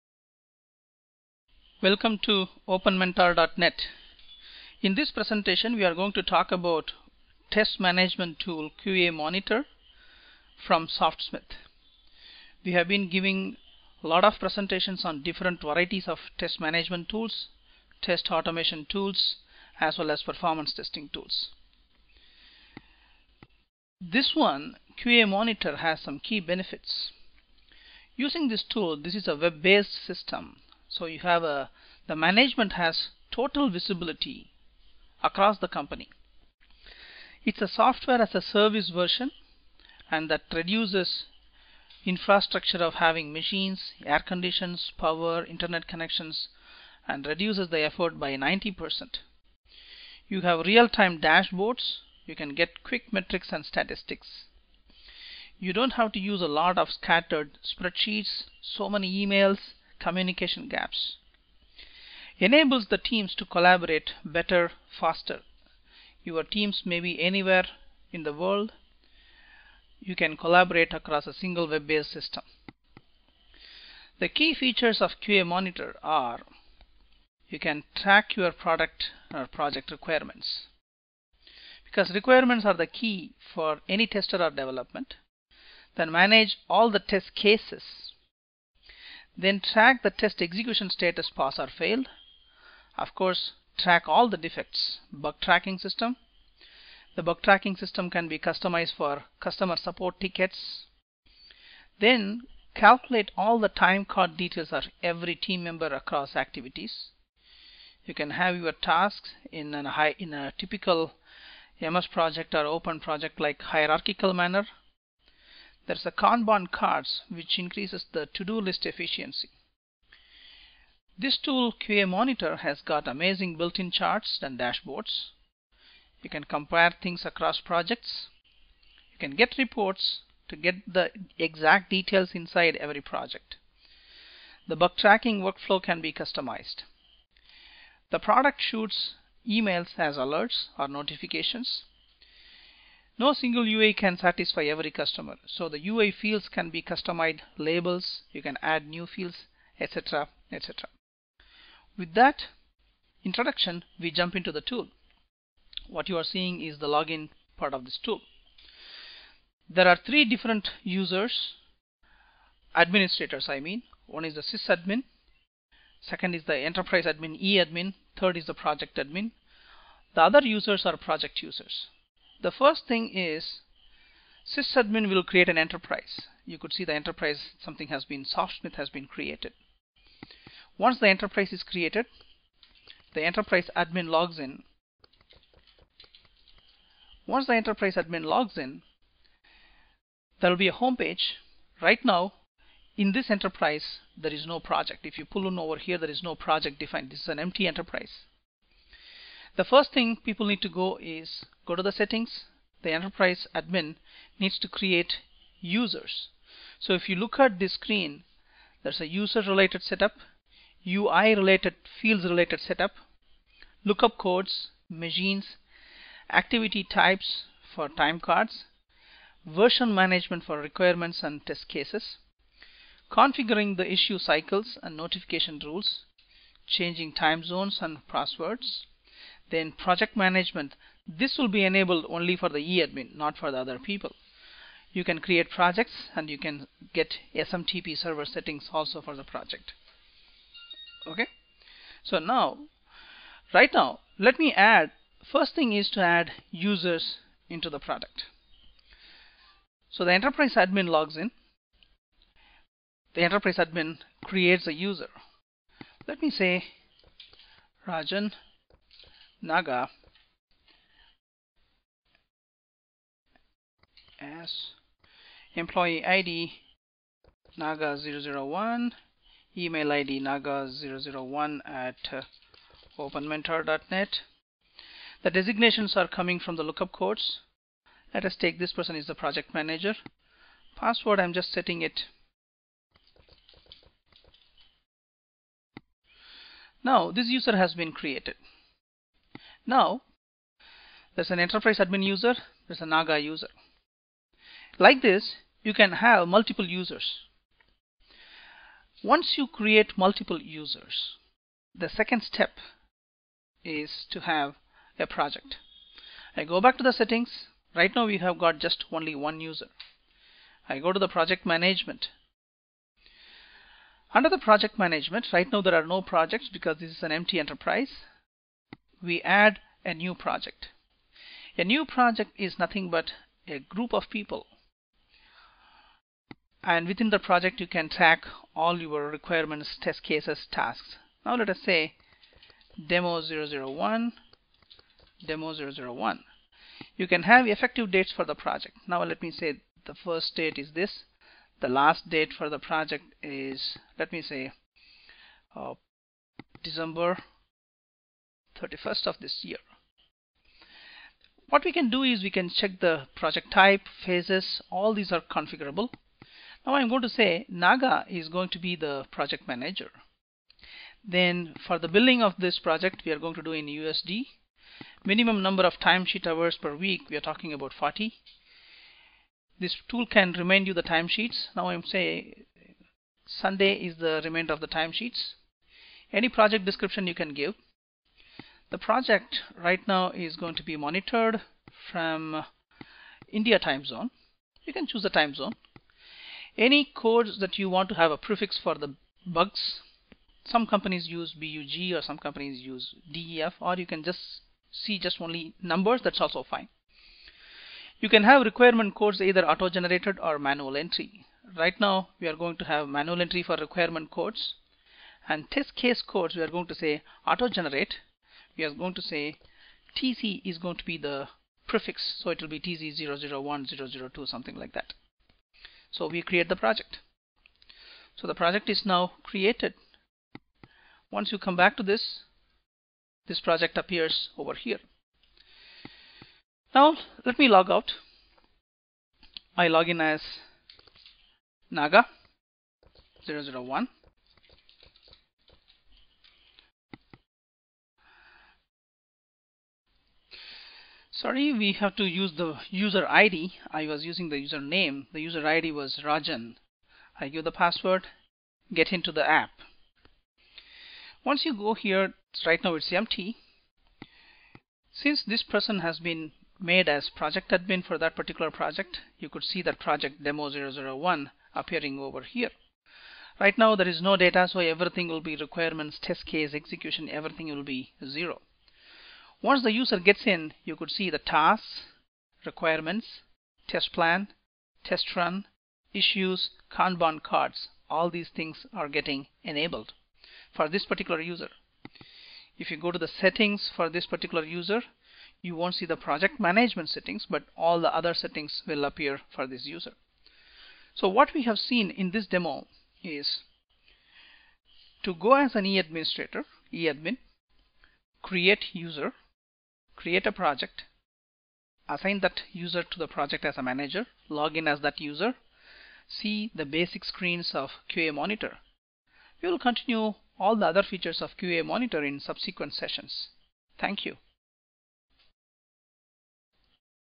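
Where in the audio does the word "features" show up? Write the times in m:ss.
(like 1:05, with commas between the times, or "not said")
1:14, 8:30.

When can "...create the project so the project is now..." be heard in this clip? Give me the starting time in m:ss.
6:56.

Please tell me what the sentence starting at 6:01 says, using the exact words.
Then for the billing of this project, we are going to do in USD.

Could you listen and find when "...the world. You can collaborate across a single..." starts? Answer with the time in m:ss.
1:08.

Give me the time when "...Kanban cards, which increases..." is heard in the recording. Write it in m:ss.
1:56.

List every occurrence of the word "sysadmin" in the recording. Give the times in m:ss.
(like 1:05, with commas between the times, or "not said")
2:44, 2:54.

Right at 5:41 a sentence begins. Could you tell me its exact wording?
The last date for the project is, let me say, uh, December 31st of this year.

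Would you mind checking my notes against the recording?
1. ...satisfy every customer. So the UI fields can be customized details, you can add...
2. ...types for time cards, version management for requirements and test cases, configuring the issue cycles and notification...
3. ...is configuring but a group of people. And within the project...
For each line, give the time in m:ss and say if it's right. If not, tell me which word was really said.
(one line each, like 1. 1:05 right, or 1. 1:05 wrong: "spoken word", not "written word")
1. 2:24 wrong: "labels", not "details"
2. 3:36 right
3. 5:22 wrong: "nothing", not "configuring".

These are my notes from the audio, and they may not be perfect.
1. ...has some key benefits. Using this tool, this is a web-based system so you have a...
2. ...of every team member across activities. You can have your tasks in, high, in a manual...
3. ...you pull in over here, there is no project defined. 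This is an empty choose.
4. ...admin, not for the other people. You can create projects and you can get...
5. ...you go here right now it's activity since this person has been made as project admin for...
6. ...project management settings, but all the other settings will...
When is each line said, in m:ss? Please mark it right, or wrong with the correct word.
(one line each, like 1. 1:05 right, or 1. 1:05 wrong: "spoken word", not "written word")
1. 0:25 right
2. 1:44 wrong: "typical", not "manual"
3. 3:15 wrong: "enterprise", not "choose"
4. 3:52 right
5. 7:31 wrong: "empty", not "activity"
6. 8:05 right.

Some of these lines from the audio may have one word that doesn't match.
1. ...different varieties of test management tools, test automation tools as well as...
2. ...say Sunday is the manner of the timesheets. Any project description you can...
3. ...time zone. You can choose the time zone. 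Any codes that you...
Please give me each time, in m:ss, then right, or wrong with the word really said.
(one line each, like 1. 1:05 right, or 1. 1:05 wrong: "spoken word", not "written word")
1. 0:15 right
2. 6:11 wrong: "remainder", not "manner"
3. 6:23 right.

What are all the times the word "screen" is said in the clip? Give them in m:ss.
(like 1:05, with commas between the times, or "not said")
3:27, 8:27.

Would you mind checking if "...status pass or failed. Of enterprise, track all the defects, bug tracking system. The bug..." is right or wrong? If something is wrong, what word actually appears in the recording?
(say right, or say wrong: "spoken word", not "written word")
wrong: "course", not "enterprise".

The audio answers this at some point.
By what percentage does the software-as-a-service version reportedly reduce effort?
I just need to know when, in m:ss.
0:48.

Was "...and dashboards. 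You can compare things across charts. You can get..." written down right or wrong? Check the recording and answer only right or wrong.
wrong.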